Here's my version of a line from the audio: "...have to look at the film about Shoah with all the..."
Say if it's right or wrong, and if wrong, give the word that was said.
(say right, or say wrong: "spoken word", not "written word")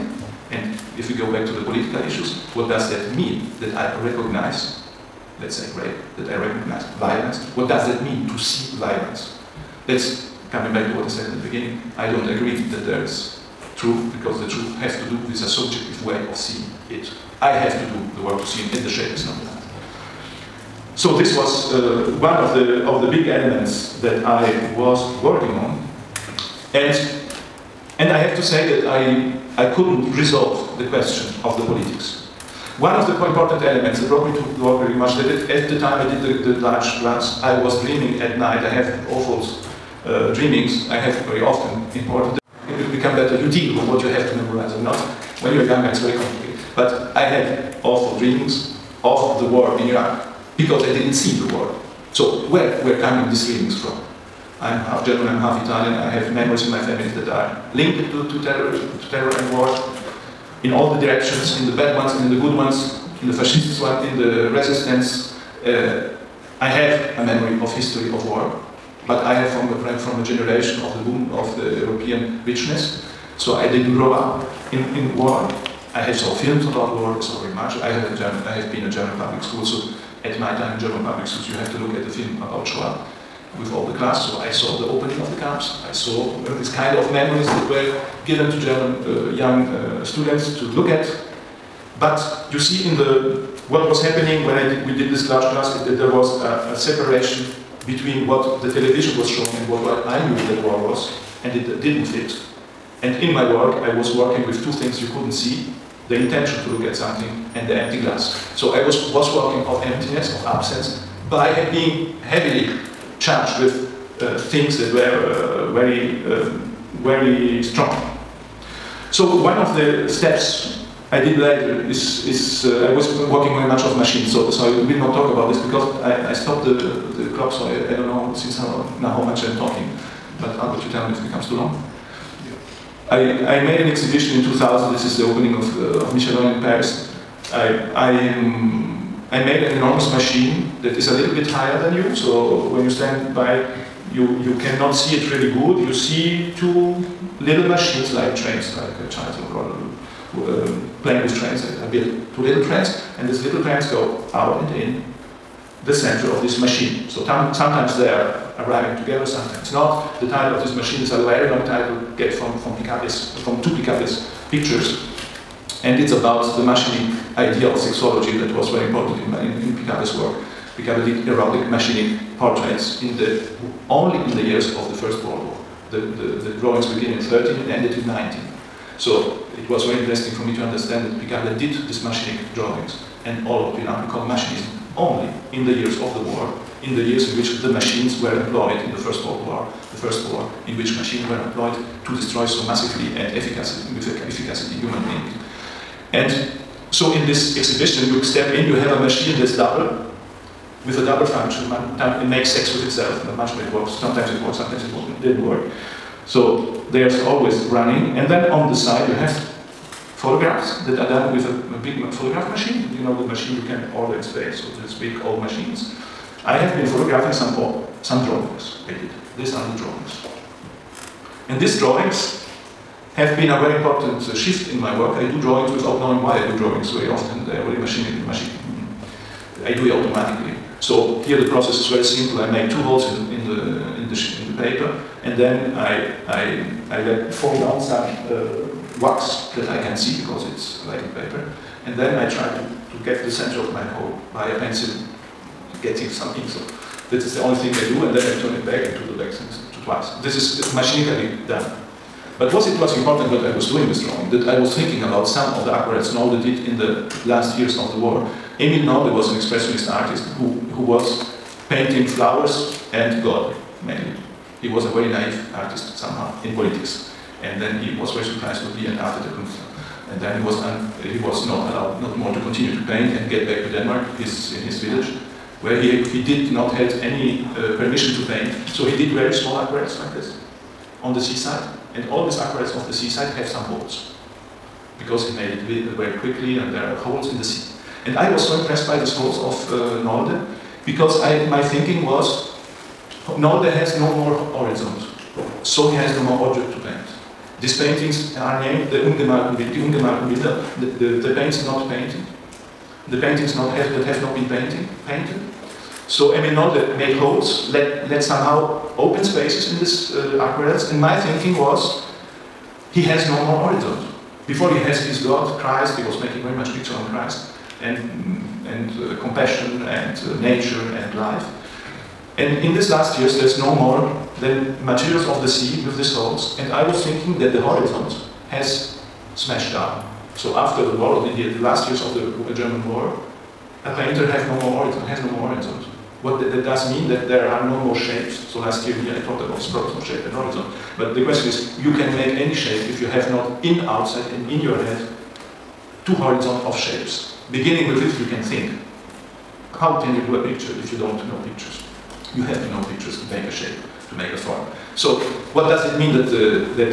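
right.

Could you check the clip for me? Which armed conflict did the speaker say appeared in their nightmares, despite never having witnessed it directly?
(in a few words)
The war in Iraq.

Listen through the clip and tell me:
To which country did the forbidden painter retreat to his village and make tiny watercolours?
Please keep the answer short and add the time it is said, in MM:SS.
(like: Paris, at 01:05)
Denmark, at 04:33.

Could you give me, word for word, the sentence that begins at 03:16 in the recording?
And so in this exhibition, you step in, you have a machine that's double, with a double function.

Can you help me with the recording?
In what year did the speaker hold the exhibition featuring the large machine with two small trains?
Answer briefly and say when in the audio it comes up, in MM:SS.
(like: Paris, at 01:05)
2000, at 02:14.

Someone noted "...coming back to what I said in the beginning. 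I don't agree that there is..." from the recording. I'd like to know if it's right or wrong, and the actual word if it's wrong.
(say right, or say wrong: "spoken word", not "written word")
right.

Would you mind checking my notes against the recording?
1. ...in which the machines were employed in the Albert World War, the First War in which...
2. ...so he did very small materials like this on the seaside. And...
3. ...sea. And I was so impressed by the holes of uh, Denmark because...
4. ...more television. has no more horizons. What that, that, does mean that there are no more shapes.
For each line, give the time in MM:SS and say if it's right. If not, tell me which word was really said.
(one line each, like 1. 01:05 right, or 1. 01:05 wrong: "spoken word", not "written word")
1. 03:07 wrong: "First", not "Albert"
2. 04:38 wrong: "aquarels", not "materials"
3. 04:47 wrong: "Nolde", not "Denmark"
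4. 05:34 wrong: "horizon", not "television".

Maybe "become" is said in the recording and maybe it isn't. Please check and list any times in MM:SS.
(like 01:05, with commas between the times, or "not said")
00:42, 02:11.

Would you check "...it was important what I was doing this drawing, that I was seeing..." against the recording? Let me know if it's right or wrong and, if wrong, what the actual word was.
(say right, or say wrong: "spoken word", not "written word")
wrong: "thinking", not "seeing".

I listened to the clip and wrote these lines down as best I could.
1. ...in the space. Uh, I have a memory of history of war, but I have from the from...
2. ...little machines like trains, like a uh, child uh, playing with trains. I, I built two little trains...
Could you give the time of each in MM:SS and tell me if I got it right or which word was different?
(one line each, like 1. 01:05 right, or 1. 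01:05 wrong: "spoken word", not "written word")
1. 01:04 wrong: "resistance", not "space"
2. 02:27 right.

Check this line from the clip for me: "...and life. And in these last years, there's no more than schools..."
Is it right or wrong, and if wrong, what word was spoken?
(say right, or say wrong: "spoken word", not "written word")
wrong: "materials", not "schools".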